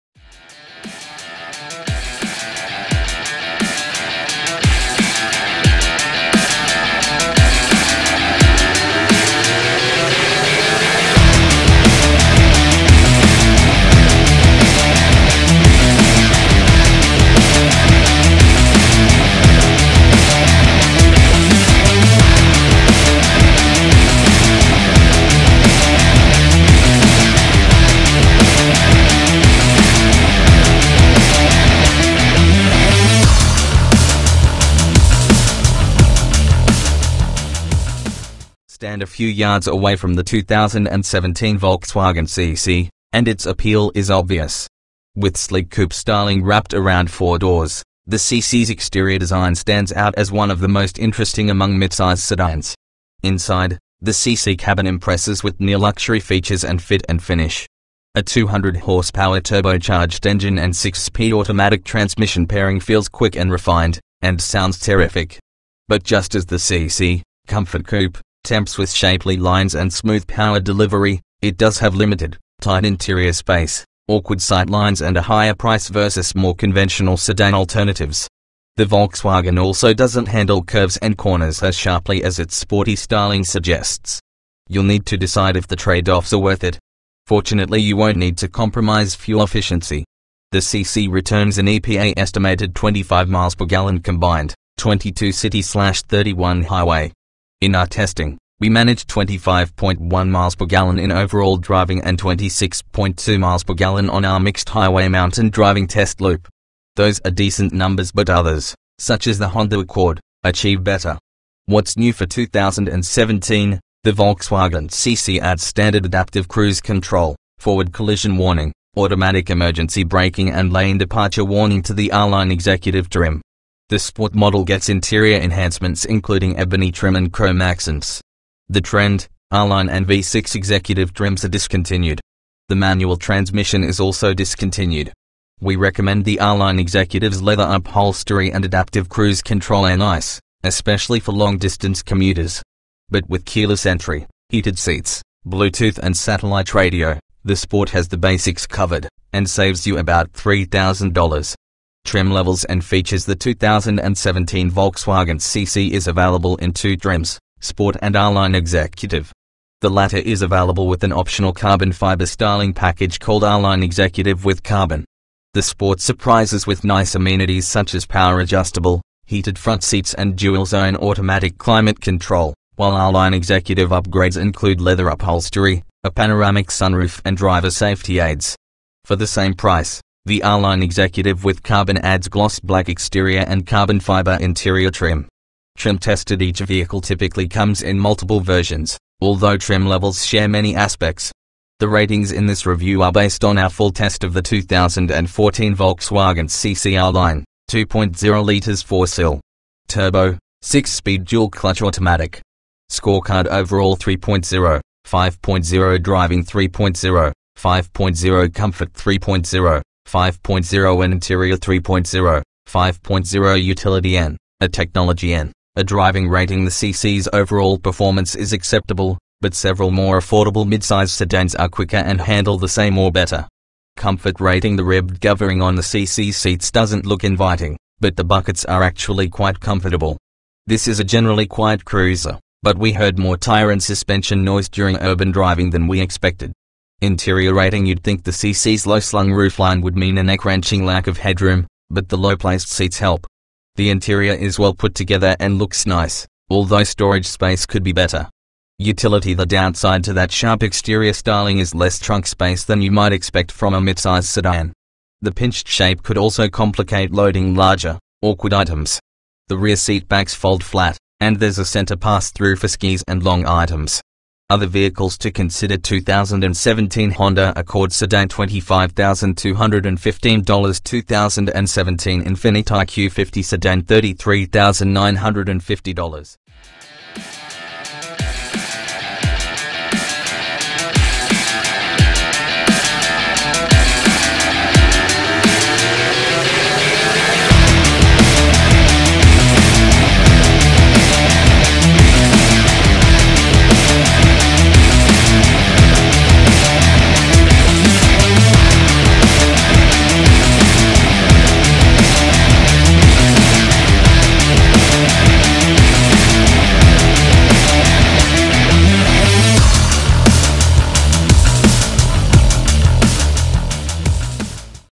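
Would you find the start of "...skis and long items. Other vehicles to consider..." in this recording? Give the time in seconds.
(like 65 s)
262 s.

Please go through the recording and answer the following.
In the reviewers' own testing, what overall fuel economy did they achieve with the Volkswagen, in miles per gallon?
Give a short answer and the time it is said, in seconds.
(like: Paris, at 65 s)
25.1, at 99 s.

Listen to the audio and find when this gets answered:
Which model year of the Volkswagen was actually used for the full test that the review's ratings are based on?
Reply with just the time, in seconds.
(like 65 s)
194 s.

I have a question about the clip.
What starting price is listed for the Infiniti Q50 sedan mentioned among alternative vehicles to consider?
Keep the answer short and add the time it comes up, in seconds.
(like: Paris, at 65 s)
$33,950, at 273 s.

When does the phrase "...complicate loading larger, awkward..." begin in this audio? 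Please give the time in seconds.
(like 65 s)
256 s.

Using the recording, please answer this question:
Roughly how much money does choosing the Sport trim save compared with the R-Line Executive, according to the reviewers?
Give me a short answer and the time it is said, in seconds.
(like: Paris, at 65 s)
$3,000, at 150 s.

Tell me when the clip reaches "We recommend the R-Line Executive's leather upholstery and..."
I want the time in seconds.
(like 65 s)
135 s.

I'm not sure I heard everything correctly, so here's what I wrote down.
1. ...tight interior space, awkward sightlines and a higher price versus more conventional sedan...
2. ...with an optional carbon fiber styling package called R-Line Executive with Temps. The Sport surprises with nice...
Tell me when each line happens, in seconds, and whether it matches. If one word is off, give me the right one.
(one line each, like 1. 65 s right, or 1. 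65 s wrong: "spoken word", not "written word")
1. 72 s right
2. 160 s wrong: "Carbon", not "Temps".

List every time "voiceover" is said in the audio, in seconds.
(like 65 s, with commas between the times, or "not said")
not said.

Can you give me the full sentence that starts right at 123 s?
This sport model gets interior enhancements including ebony trim and chrome accents.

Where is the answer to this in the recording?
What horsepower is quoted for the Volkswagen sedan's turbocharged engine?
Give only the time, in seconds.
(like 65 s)
58 s.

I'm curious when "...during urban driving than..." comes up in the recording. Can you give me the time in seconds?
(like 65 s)
234 s.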